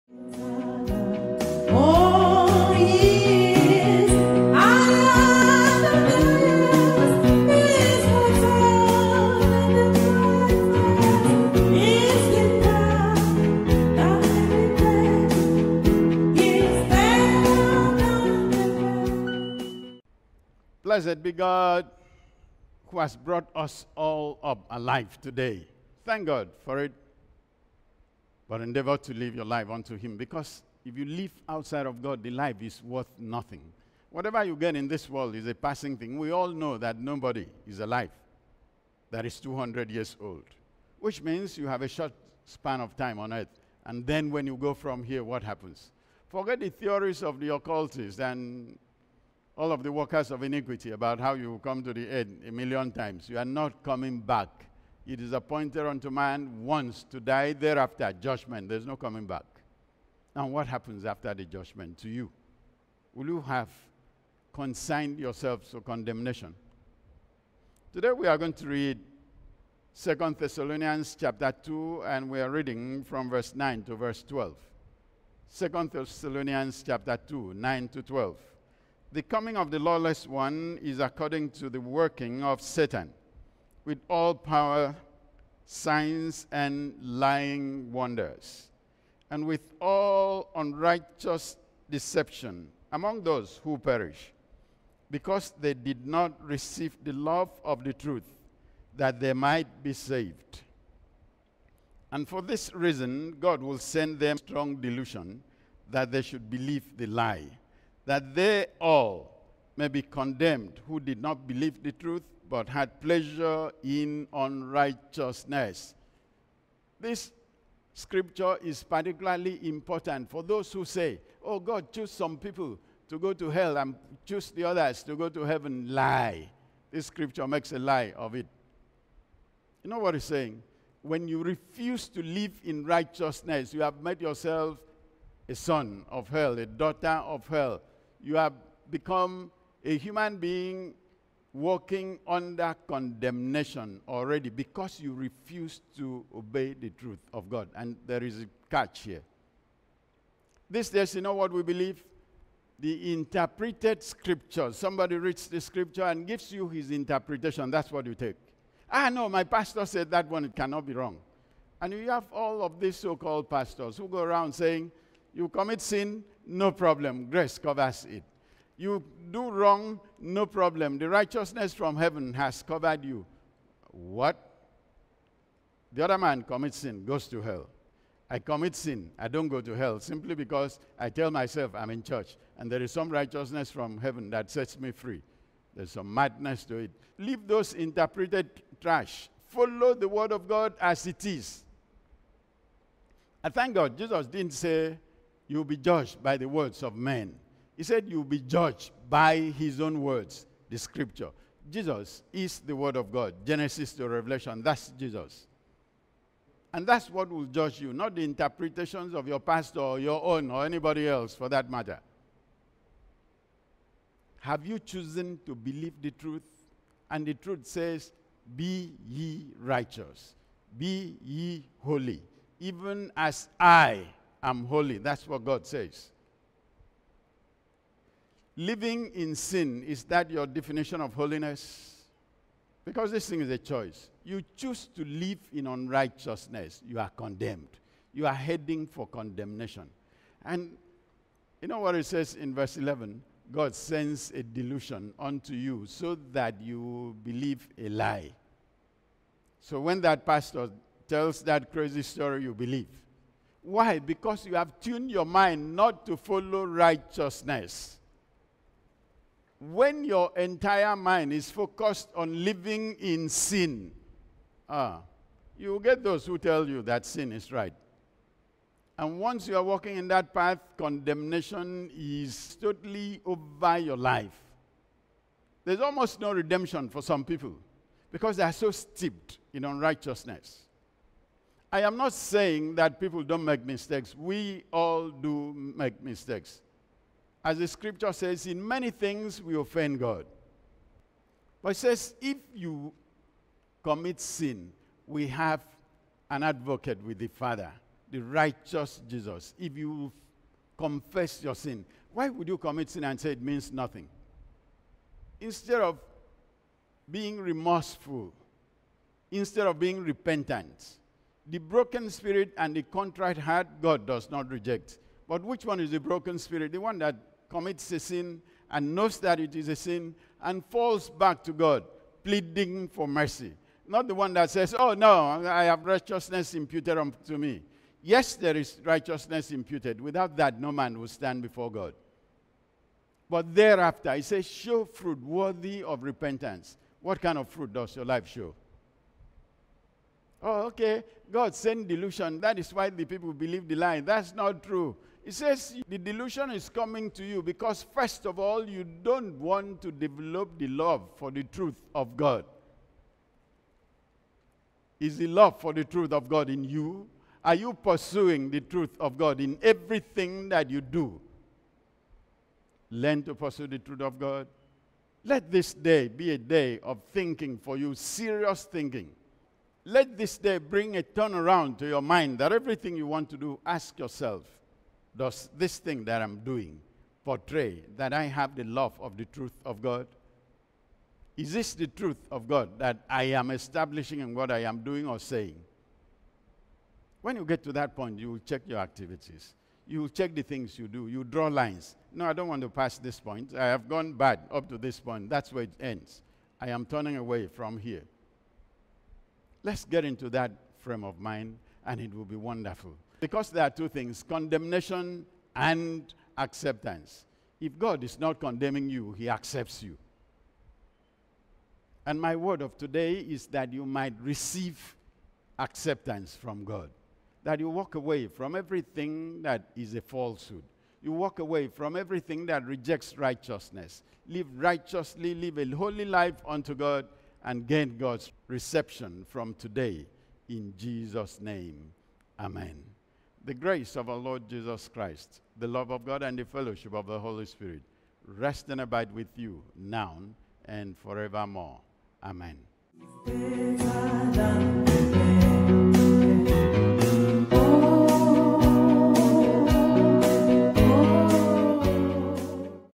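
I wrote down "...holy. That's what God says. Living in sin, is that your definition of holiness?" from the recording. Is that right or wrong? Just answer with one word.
right.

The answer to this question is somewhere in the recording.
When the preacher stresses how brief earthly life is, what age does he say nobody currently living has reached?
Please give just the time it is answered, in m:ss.
0:39.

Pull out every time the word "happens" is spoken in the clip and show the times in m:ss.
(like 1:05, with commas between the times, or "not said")
0:45, 1:00.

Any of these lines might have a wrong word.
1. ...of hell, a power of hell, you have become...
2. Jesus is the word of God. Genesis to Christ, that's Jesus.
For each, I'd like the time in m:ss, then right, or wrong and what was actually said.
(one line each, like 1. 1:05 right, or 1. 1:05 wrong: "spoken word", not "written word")
1. 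2:16 wrong: "daughter", not "power"
2. 3:21 wrong: "Revelation", not "Christ".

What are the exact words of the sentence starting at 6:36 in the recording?
I am turning away from here.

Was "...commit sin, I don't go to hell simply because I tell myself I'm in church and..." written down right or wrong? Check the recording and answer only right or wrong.
right.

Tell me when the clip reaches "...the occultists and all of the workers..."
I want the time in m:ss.
0:47.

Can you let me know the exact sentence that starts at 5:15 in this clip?
But which one is the broken spirit?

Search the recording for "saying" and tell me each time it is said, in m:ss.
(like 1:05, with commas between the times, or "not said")
2:10, 2:44, 4:42, 6:25.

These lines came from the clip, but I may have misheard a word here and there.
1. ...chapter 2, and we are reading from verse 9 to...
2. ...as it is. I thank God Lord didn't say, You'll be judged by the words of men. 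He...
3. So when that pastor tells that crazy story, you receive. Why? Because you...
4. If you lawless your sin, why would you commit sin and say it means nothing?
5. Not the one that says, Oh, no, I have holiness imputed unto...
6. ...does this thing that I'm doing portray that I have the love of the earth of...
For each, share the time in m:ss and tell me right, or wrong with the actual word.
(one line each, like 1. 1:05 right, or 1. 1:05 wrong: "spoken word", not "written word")
1. 1:11 right
2. 3:10 wrong: "Jesus", not "Lord"
3. 4:09 wrong: "believe", not "receive"
4. 4:59 wrong: "confess", not "lawless"
5. 5:23 wrong: "righteousness", not "holiness"
6. 6:15 wrong: "truth", not "earth".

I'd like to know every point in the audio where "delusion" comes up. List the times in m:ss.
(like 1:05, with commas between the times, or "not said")
1:44, 4:04, 5:41, 5:45.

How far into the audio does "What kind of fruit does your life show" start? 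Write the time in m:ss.
5:37.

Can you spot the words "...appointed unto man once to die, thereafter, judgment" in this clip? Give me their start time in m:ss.
0:55.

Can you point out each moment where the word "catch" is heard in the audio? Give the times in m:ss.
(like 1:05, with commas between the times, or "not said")
2:28.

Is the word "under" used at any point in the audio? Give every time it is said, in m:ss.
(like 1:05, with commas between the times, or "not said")
2:22.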